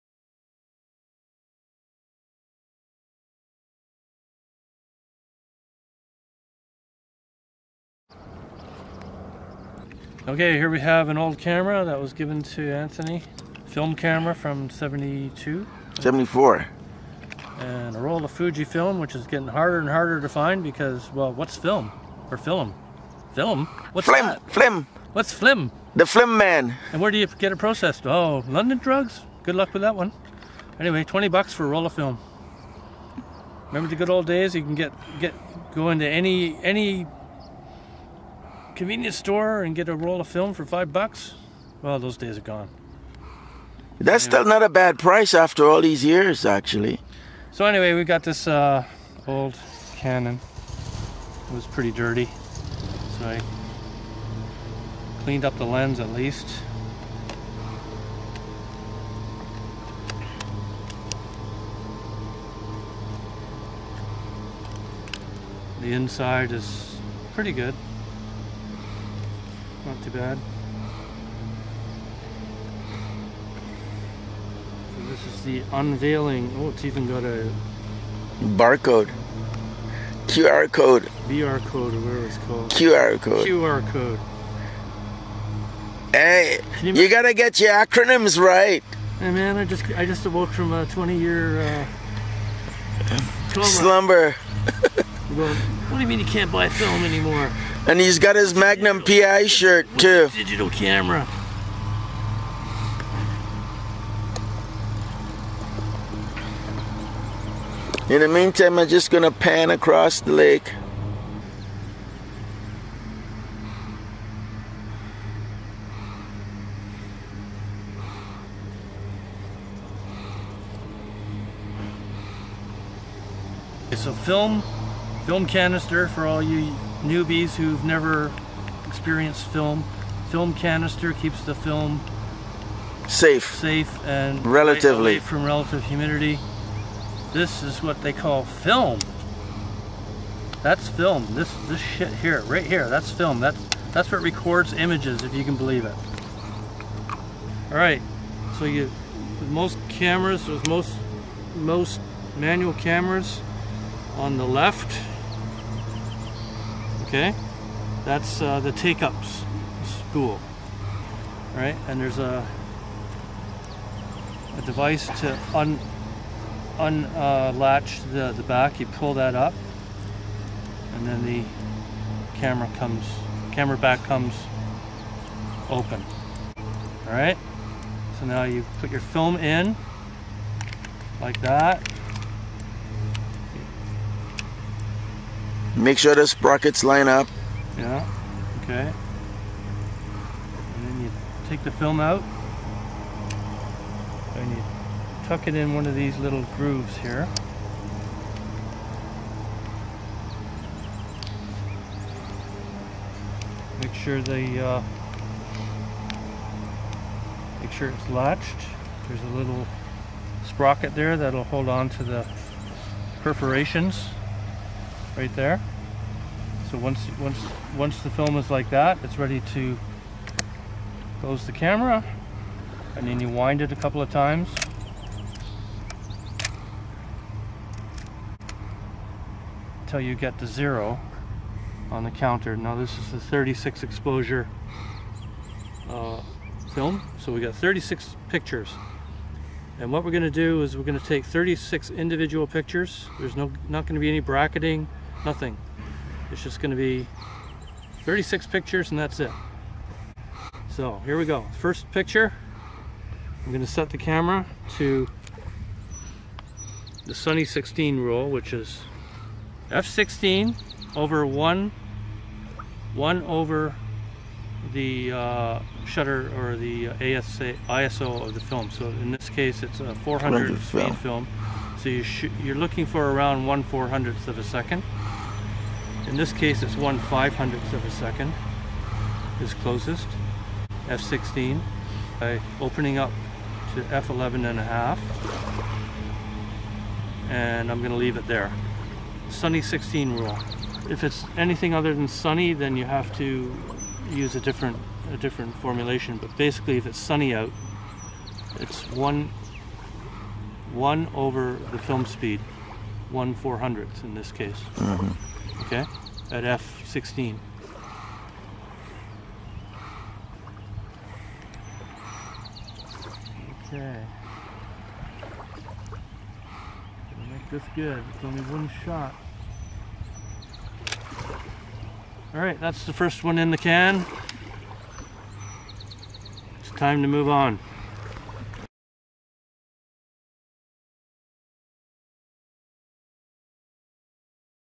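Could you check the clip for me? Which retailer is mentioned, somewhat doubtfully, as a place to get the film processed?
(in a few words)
London Drugs.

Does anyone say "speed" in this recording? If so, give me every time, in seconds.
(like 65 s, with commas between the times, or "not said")
270 s, 302 s.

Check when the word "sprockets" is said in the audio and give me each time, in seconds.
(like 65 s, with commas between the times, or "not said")
186 s, 210 s.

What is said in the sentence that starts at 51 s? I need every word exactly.
It was pretty dirty, so I cleaned up the lens at least.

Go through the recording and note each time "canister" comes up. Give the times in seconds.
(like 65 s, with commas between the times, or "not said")
125 s, 130 s.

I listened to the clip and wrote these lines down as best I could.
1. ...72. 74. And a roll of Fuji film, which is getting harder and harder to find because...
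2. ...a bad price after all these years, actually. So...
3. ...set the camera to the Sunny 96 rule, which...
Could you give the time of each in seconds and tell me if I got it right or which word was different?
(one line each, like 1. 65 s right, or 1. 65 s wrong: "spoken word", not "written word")
1. 14 s right
2. 44 s right
3. 253 s wrong: "16", not "96".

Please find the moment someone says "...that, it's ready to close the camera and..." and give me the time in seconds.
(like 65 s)
218 s.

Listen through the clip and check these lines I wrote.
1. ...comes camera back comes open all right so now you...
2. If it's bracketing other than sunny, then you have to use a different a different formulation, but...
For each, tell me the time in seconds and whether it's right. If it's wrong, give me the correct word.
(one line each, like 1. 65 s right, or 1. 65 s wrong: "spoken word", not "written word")
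1. 172 s right
2. 290 s wrong: "anything", not "bracketing".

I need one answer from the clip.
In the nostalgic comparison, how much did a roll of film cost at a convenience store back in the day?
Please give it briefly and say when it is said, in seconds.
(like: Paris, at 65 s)
$5, at 40 s.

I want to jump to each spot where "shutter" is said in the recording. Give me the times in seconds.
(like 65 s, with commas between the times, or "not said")
265 s.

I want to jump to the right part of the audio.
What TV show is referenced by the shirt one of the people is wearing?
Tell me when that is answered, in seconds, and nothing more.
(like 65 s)
98 s.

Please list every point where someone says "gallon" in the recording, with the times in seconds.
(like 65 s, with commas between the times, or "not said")
not said.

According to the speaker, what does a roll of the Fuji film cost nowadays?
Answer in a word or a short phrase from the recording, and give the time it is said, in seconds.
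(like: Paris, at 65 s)
$20, at 31 s.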